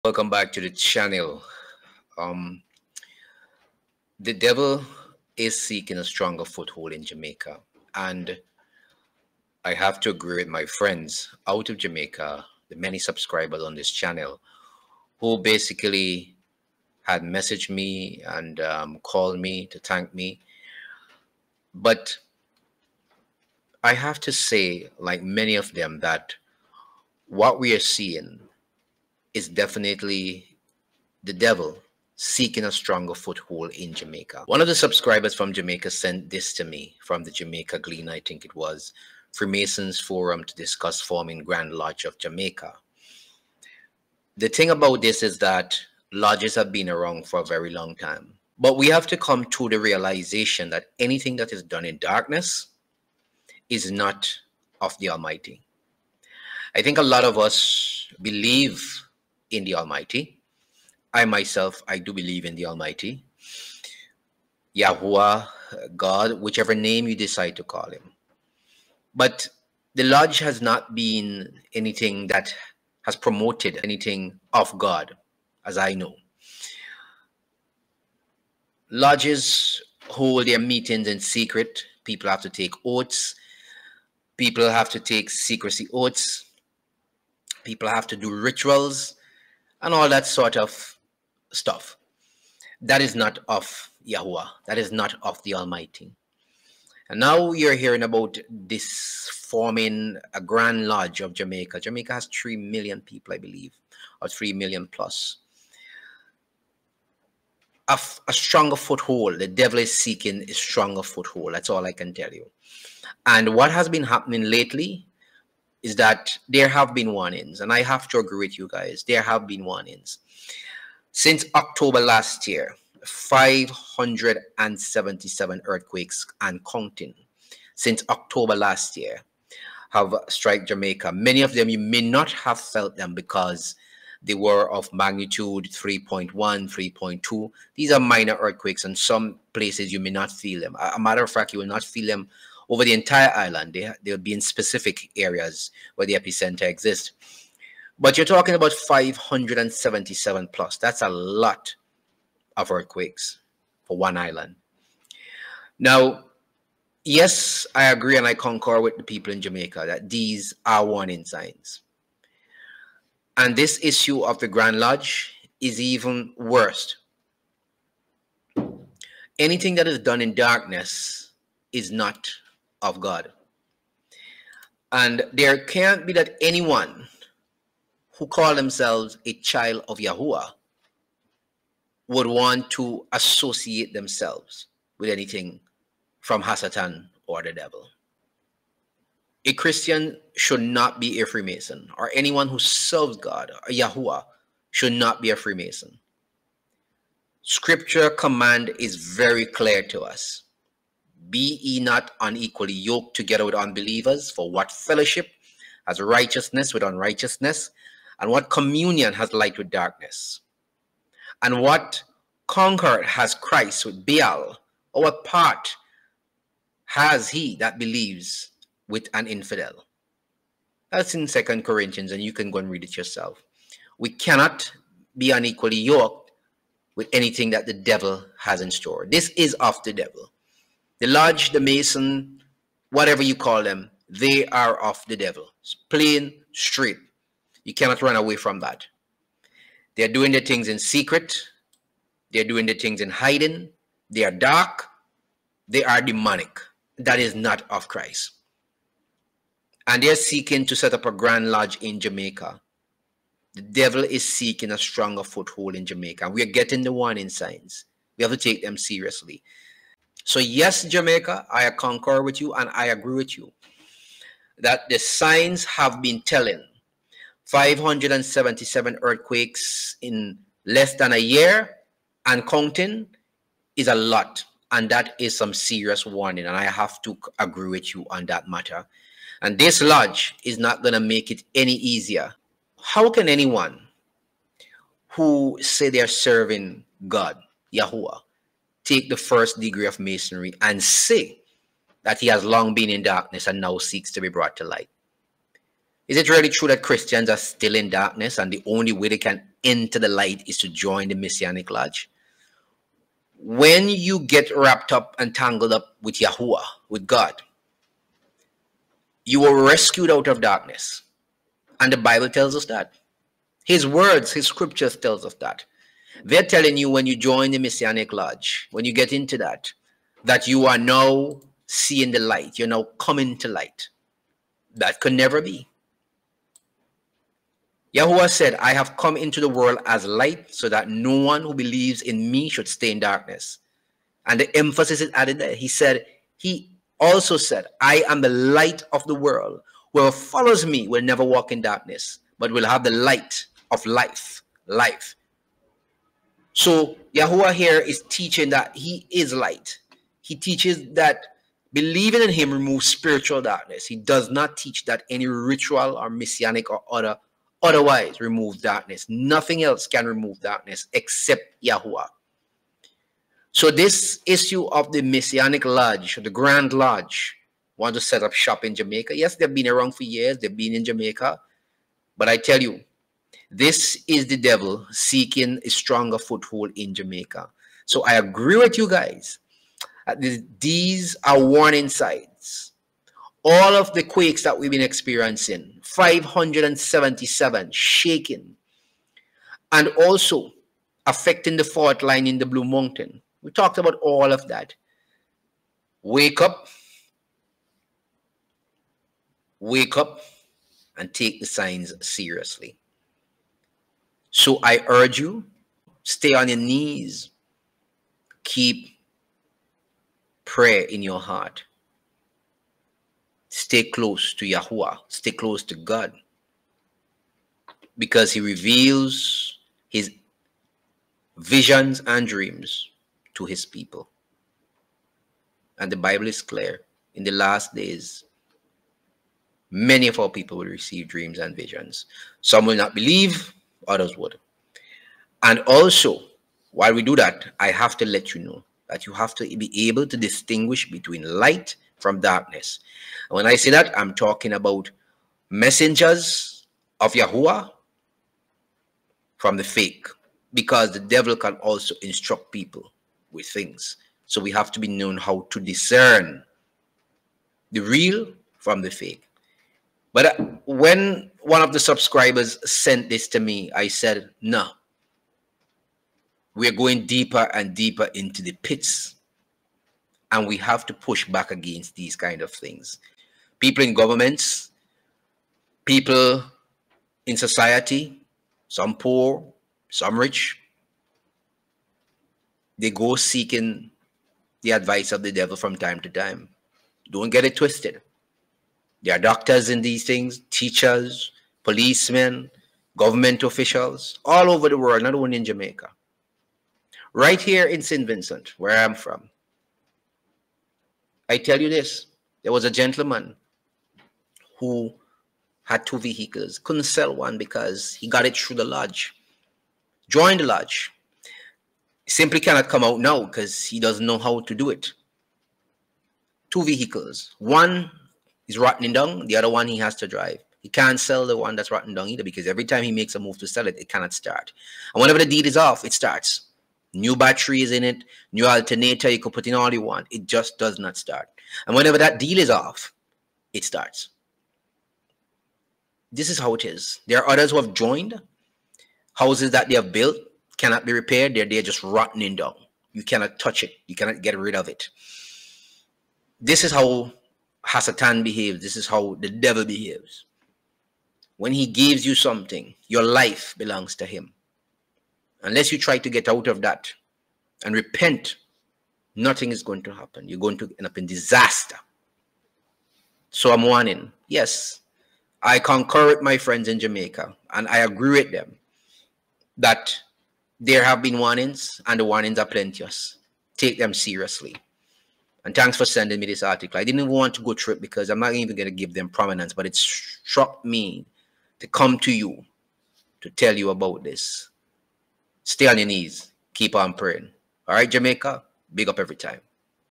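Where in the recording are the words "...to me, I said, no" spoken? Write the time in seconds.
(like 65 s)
463 s.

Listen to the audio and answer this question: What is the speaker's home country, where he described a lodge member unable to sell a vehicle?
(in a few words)
St. Vincent.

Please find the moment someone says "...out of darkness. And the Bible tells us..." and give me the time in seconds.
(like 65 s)
310 s.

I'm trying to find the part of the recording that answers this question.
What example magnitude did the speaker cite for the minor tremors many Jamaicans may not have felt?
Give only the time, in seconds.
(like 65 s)
135 s.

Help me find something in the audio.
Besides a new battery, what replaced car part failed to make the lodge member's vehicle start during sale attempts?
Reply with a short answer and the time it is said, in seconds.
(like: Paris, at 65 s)
alternator, at 528 s.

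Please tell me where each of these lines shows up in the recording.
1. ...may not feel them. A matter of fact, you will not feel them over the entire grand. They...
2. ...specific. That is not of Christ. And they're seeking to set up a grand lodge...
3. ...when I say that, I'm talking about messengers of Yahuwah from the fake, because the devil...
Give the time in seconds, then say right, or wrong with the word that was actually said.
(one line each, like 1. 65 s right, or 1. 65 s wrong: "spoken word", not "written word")
1. 139 s wrong: "island", not "grand"
2. 246 s wrong: "demonic", not "specific"
3. 443 s right.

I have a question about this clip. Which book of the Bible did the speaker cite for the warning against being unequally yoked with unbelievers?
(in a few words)
Second Corinthians.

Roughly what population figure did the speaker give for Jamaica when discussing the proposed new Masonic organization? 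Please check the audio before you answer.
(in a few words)
3 million.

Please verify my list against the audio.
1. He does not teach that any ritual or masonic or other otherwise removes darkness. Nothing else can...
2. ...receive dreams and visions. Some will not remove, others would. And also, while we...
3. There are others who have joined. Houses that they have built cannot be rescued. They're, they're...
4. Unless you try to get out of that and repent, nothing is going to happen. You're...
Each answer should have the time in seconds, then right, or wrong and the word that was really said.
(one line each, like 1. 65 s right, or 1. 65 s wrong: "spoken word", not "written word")
1. 353 s right
2. 430 s wrong: "believe", not "remove"
3. 537 s wrong: "repaired", not "rescued"
4. 555 s right.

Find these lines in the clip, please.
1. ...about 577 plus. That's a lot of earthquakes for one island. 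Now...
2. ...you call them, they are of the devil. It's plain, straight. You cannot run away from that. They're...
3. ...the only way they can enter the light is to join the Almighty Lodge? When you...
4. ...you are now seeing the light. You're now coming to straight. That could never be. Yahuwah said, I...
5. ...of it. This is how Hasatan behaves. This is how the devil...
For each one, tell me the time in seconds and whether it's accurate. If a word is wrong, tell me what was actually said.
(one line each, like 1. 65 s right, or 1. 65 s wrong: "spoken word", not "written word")
1. 148 s right
2. 233 s right
3. 298 s wrong: "Masonic", not "Almighty"
4. 320 s wrong: "light", not "straight"
5. 544 s right.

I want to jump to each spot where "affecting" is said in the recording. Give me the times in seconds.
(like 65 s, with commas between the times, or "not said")
391 s.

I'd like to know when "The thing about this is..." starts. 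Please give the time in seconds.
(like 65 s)
44 s.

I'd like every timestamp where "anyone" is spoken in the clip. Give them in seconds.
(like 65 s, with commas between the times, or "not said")
176 s, 192 s, 283 s.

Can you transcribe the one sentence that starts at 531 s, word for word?
And whenever that deal is off, it starts.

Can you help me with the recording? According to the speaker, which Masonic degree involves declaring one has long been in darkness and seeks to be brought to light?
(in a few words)
first degree.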